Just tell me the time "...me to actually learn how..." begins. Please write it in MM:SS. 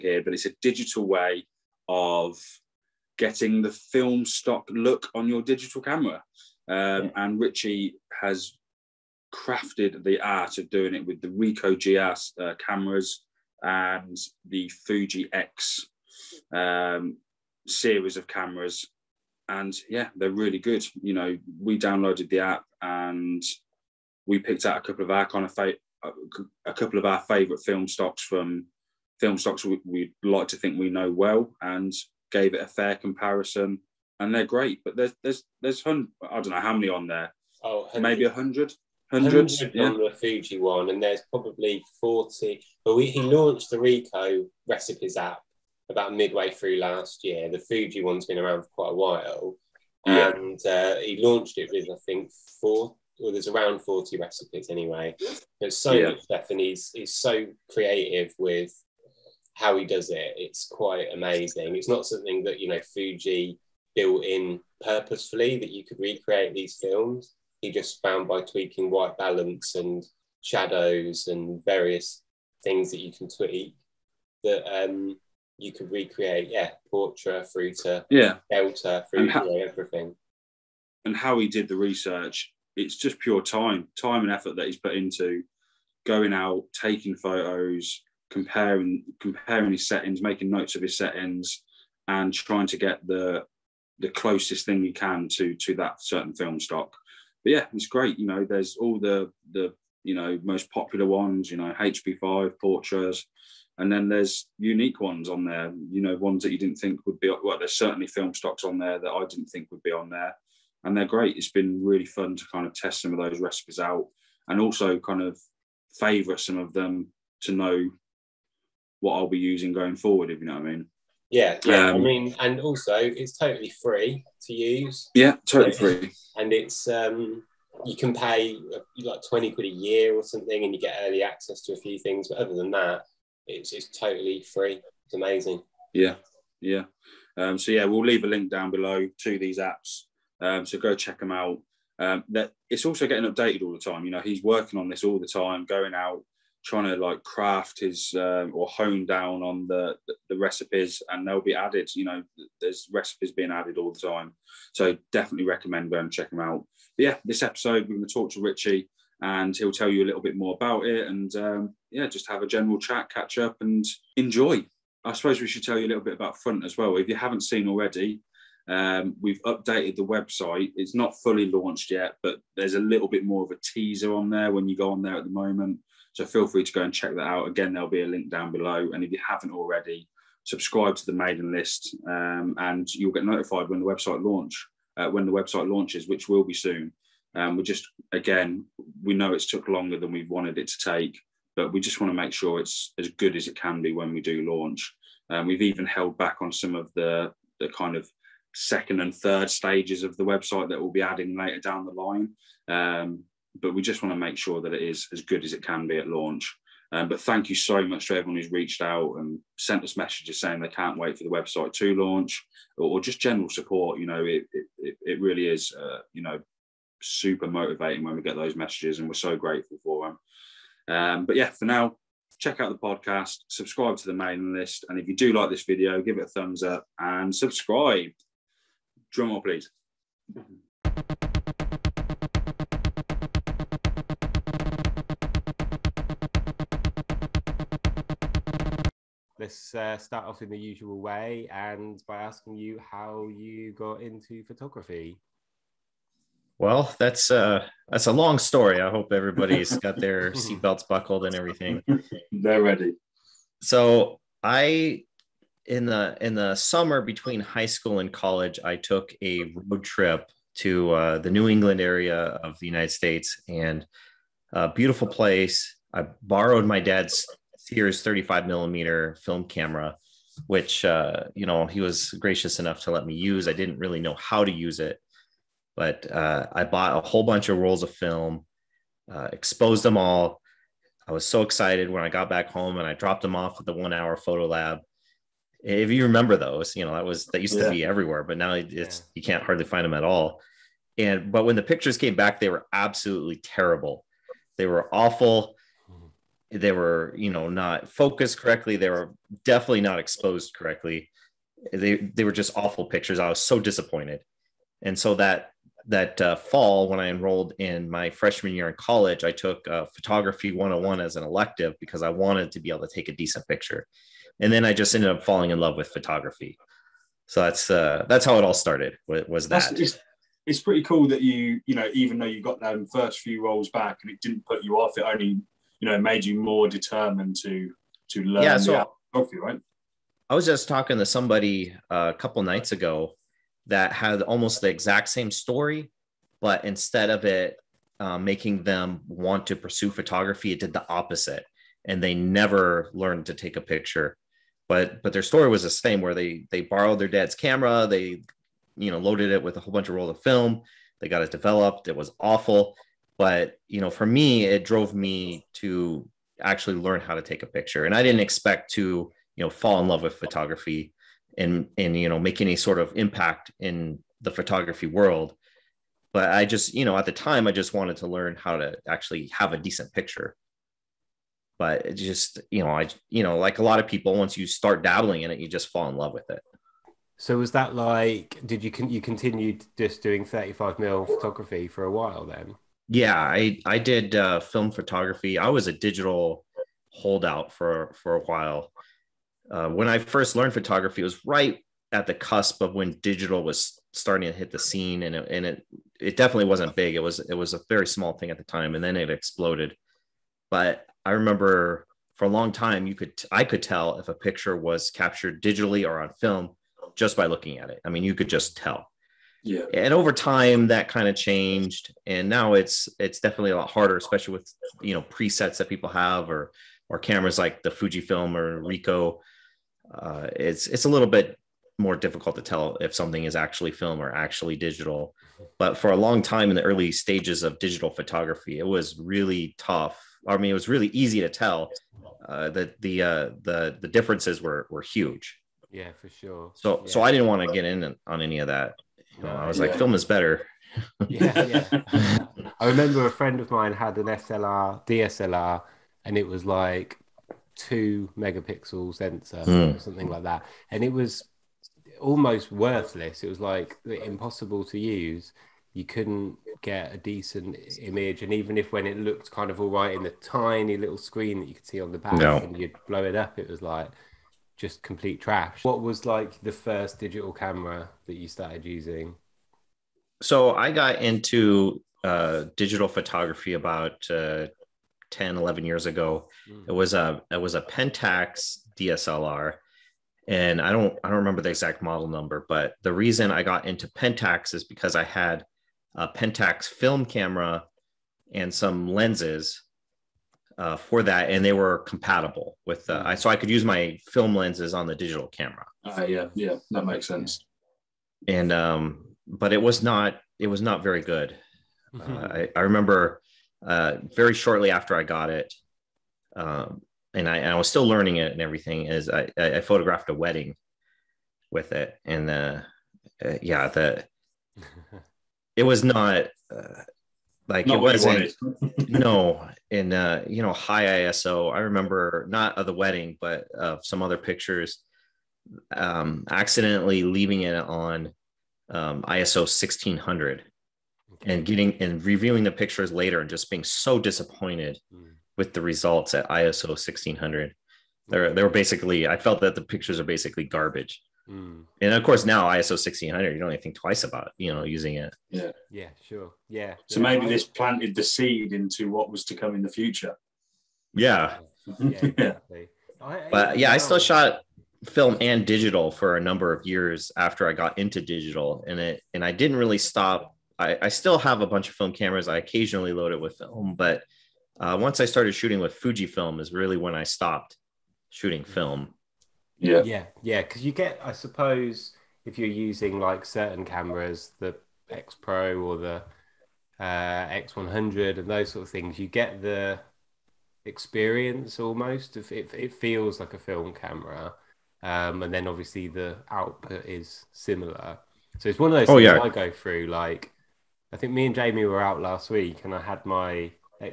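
05:54.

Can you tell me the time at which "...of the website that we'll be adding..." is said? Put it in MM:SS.
03:20.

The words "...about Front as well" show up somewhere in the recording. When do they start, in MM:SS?
02:46.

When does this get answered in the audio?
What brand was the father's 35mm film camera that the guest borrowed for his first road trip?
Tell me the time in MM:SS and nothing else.
04:27.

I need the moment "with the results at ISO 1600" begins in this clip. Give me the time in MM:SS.
08:55.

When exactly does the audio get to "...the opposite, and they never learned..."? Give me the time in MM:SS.
05:40.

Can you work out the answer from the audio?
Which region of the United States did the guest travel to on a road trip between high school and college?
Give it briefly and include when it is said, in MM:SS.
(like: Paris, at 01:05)
New England, at 04:21.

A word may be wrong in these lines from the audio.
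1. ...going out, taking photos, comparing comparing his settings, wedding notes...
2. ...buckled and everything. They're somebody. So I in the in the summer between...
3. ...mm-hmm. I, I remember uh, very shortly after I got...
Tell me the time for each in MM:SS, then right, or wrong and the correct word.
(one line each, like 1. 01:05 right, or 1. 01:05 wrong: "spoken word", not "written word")
1. 01:26 wrong: "making", not "wedding"
2. 04:10 wrong: "ready", not "somebody"
3. 08:21 right.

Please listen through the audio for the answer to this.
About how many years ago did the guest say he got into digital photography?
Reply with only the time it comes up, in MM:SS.
07:55.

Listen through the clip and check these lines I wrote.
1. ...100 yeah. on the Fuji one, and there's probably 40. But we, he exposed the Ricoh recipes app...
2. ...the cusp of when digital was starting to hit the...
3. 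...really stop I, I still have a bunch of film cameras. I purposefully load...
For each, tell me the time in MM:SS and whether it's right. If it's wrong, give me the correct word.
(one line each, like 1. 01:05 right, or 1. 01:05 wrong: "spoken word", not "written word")
1. 00:39 wrong: "launched", not "exposed"
2. 06:32 right
3. 09:19 wrong: "occasionally", not "purposefully".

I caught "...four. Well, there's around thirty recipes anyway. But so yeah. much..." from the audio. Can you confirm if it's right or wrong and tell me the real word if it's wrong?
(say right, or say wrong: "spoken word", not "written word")
wrong: "forty", not "thirty".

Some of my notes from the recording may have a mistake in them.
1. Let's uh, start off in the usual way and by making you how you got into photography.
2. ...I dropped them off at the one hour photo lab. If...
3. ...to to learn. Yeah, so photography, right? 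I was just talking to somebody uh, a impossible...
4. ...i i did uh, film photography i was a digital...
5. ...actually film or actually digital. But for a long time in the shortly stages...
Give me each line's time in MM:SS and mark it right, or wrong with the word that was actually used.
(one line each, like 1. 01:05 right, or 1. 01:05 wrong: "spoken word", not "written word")
1. 03:59 wrong: "asking", not "making"
2. 04:42 right
3. 05:27 wrong: "couple", not "impossible"
4. 06:23 right
5. 07:03 wrong: "early", not "shortly".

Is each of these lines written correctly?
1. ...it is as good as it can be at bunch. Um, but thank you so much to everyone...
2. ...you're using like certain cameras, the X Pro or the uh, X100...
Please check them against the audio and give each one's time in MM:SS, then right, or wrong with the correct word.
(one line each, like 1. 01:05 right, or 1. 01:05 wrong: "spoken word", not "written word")
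1. 03:24 wrong: "launch", not "bunch"
2. 09:32 right.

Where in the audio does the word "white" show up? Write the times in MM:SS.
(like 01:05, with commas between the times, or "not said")
01:08.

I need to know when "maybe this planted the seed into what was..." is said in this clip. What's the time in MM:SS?
09:07.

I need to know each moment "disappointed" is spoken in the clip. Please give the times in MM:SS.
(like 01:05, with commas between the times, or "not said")
05:03, 08:53.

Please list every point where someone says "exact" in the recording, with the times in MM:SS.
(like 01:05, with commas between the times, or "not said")
05:34, 08:01.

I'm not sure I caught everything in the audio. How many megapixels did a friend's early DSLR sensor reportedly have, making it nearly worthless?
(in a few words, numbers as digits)
2.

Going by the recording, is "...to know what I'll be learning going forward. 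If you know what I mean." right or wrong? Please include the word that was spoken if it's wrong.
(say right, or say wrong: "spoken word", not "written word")
wrong: "using", not "learning".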